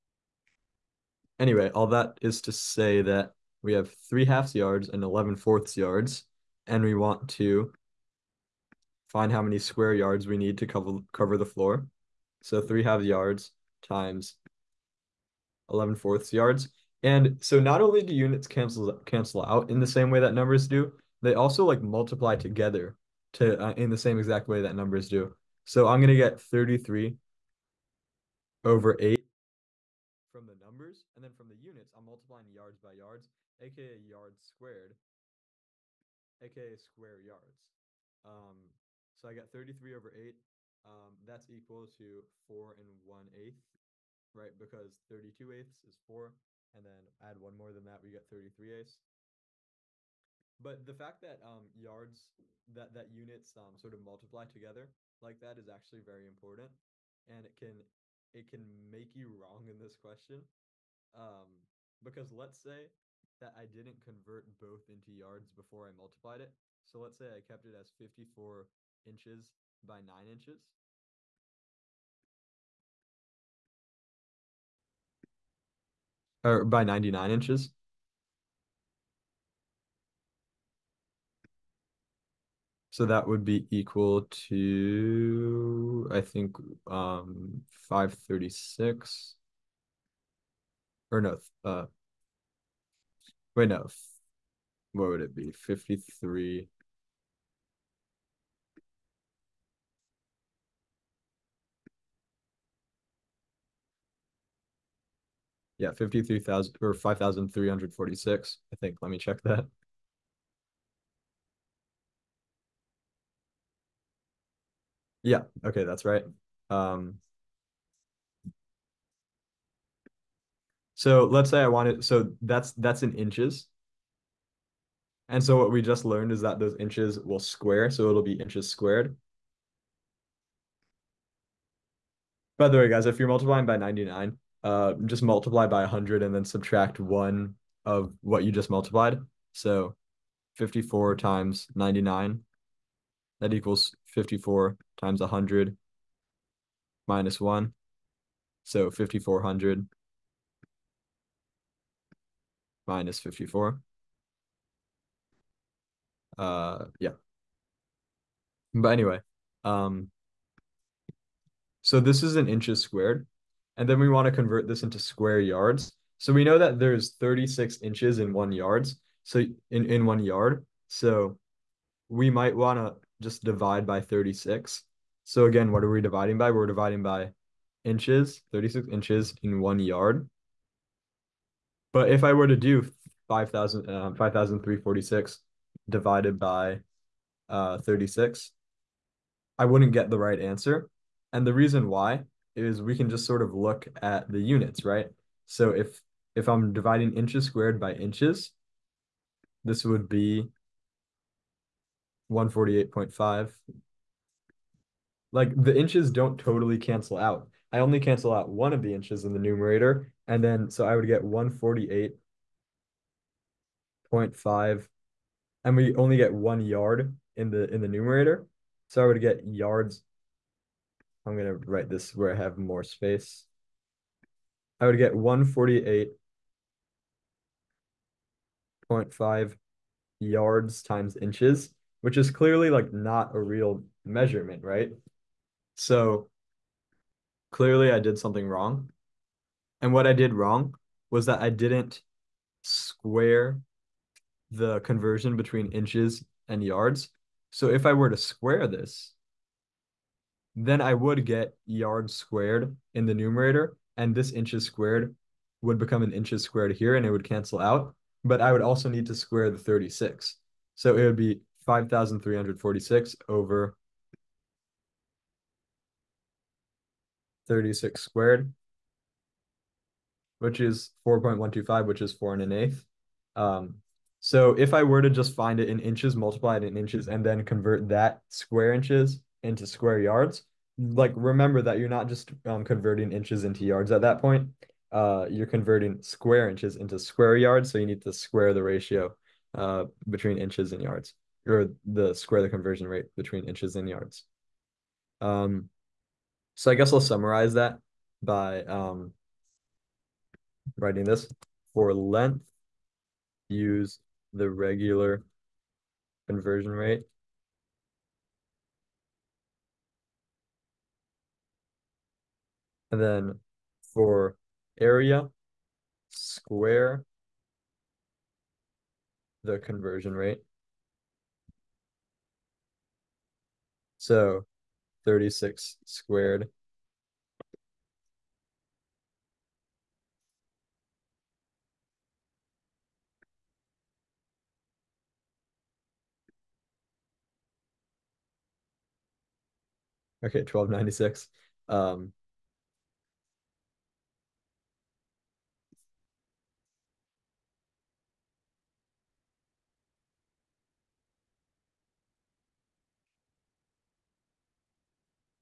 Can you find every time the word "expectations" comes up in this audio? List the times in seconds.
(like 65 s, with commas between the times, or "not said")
not said.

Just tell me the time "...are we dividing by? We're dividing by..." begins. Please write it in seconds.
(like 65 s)
175 s.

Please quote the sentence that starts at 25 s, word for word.
So I'm going to get 33 over eight from the numbers.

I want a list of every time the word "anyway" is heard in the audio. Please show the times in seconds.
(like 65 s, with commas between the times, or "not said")
1 s, 158 s.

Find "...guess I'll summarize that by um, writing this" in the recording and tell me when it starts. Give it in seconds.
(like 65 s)
296 s.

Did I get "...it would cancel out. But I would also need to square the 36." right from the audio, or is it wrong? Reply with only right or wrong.
right.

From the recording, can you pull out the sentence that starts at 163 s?
And then we want to convert this into square yards.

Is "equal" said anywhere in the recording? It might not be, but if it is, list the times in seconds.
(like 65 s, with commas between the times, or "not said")
41 s, 83 s, 143 s.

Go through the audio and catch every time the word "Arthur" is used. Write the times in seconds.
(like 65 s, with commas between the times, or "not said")
not said.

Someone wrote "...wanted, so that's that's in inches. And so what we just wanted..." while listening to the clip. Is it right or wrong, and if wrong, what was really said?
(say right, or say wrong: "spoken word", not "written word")
wrong: "learned", not "wanted".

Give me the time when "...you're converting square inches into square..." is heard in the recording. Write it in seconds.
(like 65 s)
285 s.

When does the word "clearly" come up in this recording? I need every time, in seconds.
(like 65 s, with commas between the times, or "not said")
232 s, 237 s.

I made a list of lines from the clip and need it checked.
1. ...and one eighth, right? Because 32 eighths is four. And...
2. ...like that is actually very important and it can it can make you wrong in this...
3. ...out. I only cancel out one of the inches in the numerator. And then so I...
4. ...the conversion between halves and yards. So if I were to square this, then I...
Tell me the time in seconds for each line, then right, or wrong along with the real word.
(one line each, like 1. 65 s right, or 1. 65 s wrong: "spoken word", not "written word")
1. 42 s right
2. 55 s right
3. 207 s right
4. 244 s wrong: "inches", not "halves".